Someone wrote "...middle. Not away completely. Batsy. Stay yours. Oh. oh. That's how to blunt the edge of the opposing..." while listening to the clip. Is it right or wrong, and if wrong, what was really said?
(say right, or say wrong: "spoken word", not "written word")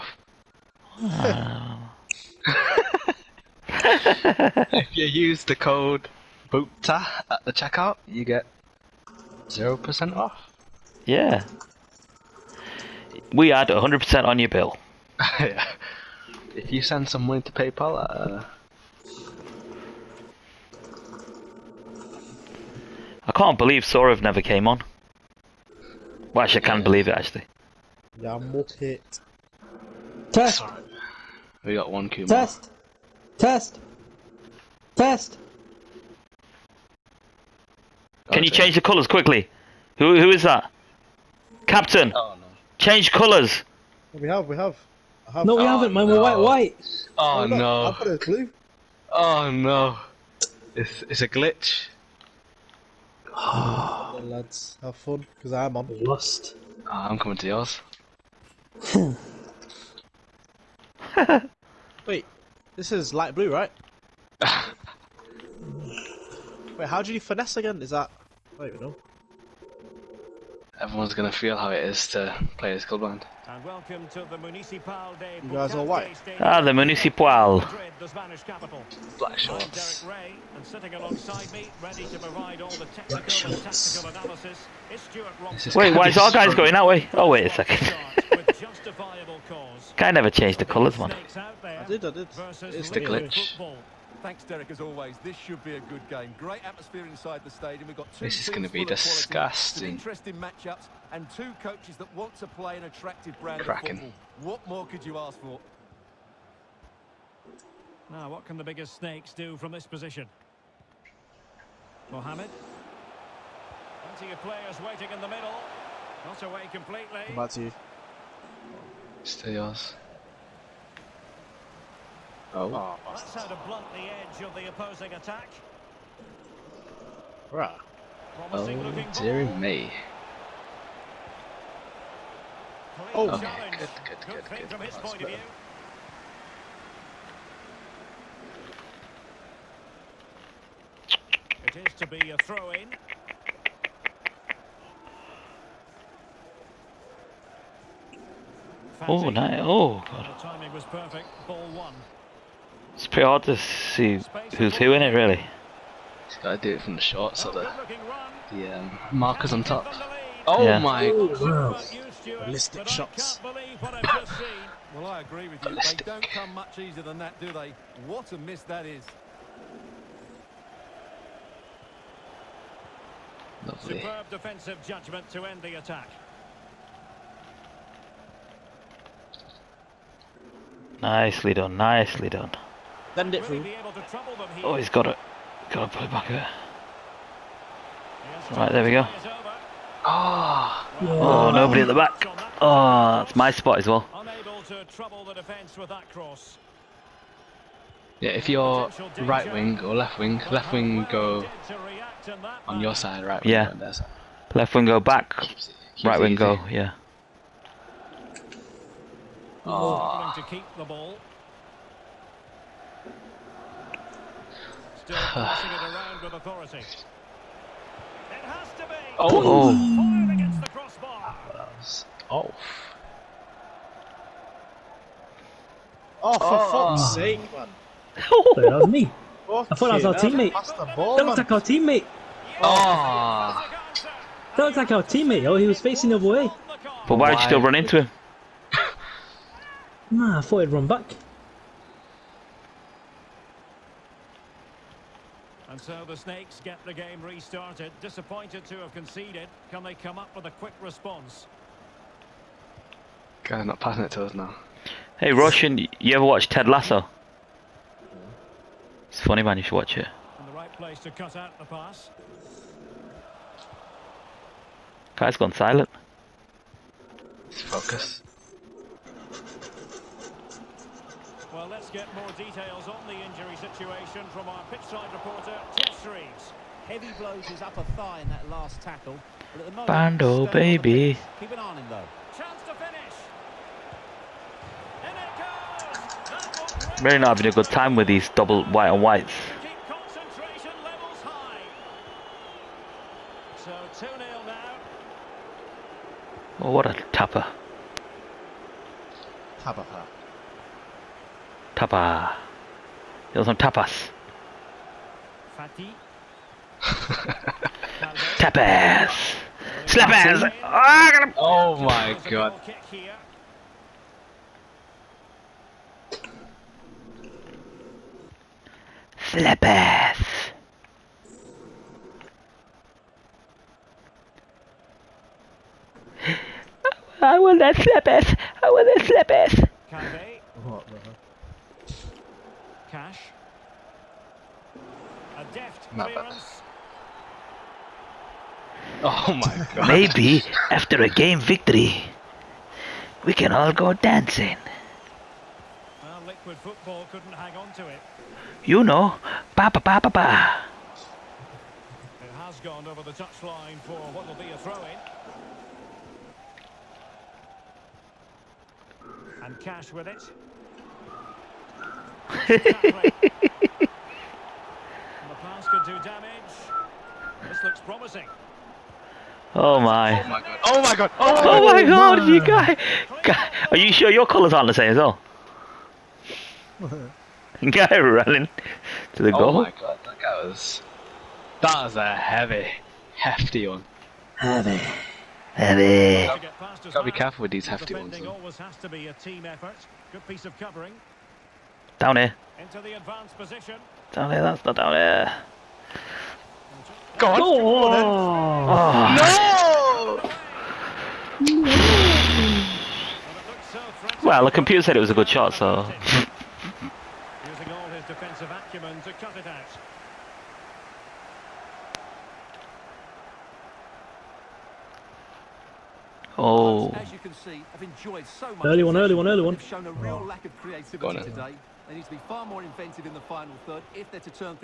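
right.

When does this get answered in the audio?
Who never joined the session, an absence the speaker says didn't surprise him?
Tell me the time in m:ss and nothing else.
0:23.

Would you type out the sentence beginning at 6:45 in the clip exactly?
Using all his defensive acumen to cut it out.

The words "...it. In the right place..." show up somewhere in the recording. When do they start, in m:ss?
4:19.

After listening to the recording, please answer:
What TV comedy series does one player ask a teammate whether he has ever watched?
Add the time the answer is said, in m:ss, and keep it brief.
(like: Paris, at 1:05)
Ted Lasso, at 4:16.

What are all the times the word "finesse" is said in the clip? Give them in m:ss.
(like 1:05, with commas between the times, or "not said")
1:07.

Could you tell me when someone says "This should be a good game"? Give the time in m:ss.
1:35.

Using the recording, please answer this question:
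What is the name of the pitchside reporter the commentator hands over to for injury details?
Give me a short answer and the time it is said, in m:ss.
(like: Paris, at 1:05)
Jess Reeves, at 4:35.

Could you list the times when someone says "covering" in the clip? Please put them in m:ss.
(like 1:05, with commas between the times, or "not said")
6:30.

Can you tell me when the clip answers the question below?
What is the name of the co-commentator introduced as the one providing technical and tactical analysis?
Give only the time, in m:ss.
1:24.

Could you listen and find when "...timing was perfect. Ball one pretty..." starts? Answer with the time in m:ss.
2:30.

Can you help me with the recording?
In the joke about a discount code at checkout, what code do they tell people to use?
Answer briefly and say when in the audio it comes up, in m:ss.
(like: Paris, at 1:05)
BOOTA, at 0:06.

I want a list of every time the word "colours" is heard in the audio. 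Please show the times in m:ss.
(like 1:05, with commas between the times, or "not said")
0:38, 0:43, 1:30, 6:14.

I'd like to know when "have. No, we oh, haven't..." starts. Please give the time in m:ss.
0:45.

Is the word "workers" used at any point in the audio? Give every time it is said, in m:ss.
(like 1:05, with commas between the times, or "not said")
not said.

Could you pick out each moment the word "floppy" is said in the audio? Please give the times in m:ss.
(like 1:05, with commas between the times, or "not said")
not said.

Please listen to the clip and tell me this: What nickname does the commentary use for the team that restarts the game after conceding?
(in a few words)
the Snakes.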